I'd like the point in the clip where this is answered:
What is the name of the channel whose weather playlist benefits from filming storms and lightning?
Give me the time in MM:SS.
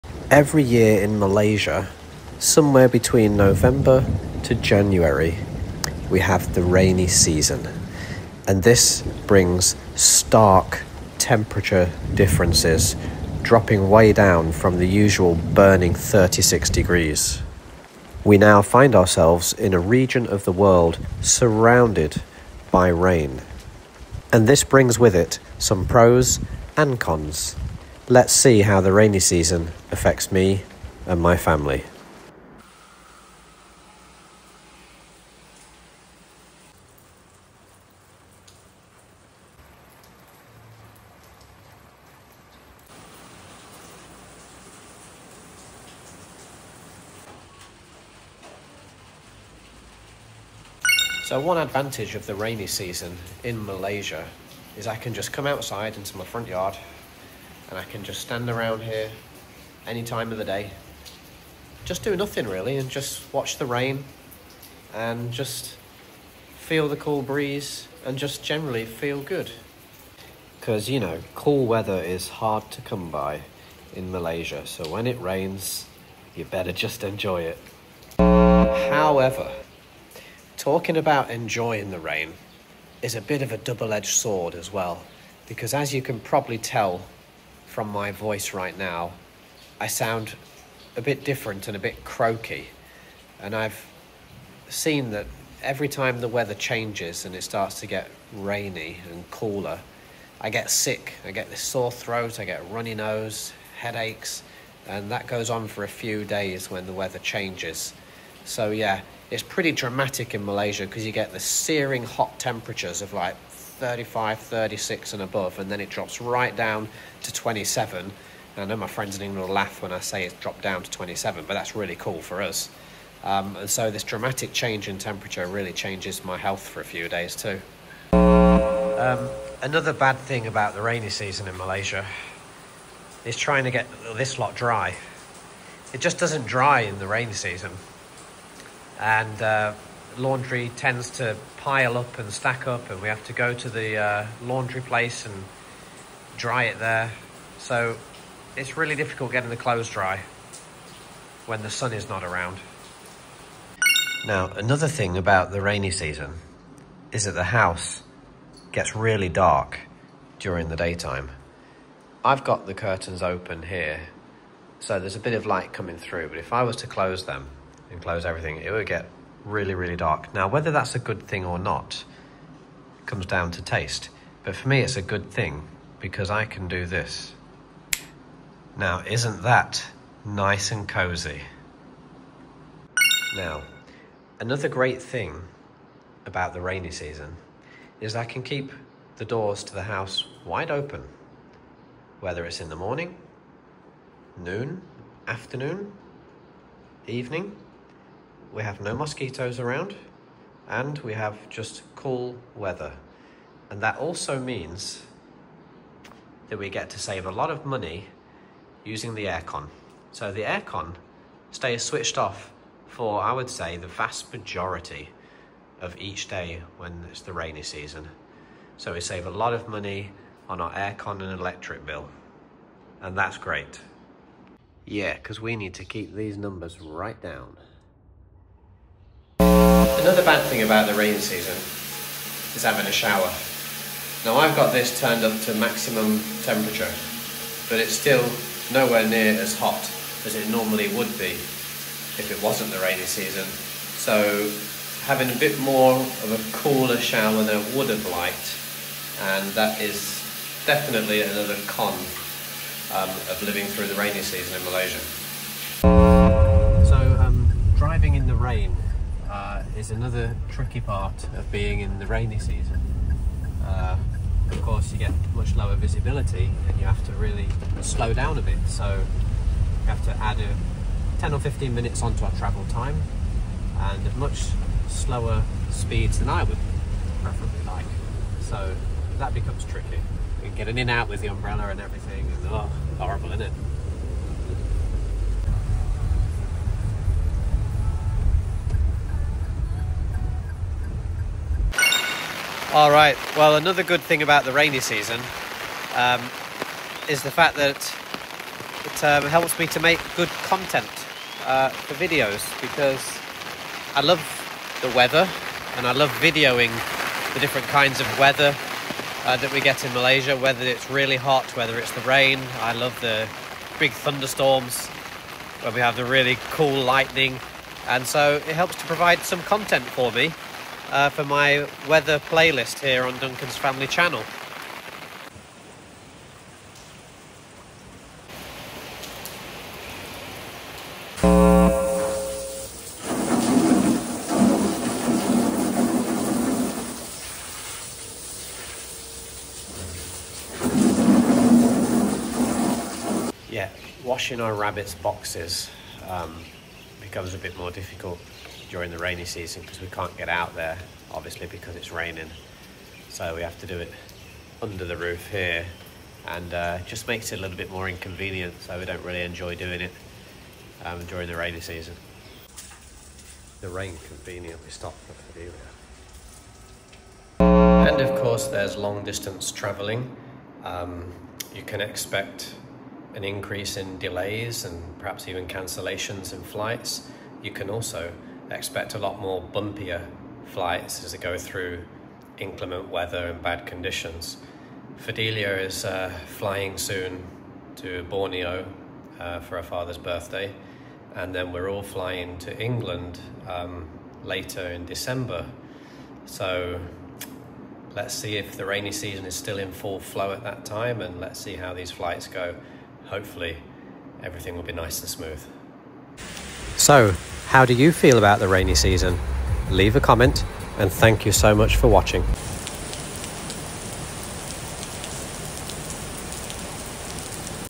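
05:23.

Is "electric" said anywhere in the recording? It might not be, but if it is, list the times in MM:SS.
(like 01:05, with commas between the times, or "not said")
03:41.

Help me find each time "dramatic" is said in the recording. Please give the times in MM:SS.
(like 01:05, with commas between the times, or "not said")
01:49, 02:04.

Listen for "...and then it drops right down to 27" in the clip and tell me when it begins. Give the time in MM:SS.
01:55.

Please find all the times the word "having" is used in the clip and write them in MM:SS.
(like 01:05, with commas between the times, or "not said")
03:52, 04:05.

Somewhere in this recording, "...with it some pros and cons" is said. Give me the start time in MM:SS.
00:24.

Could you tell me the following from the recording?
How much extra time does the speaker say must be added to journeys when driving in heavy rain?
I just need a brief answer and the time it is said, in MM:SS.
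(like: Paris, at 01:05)
10 or 15 minutes, at 04:31.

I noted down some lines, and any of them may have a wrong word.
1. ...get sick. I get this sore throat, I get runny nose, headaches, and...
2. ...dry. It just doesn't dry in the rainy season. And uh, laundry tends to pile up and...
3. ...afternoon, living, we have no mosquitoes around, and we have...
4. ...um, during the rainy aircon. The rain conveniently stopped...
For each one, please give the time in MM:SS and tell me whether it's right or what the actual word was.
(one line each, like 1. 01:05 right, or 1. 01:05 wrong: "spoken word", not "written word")
1. 01:40 right
2. 02:14 right
3. 03:15 wrong: "evening", not "living"
4. 06:00 wrong: "season", not "aircon".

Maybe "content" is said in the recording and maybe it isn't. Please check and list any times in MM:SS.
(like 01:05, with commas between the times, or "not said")
05:00, 05:19.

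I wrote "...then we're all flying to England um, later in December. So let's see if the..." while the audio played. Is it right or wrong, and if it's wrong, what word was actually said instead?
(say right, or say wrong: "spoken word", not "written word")
right.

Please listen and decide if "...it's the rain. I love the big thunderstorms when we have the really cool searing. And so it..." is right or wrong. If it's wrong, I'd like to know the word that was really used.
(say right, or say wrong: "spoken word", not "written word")
wrong: "lightning", not "searing".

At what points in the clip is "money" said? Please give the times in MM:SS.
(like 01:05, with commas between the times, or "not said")
03:27, 03:39.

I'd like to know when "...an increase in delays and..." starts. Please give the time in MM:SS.
06:13.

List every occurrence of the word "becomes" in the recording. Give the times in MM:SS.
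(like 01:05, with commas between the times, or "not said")
04:39, 05:46.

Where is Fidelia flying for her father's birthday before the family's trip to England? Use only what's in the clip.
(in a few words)
Borneo.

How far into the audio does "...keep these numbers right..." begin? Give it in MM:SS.
03:45.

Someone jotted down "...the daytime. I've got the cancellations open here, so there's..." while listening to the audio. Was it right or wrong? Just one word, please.
wrong.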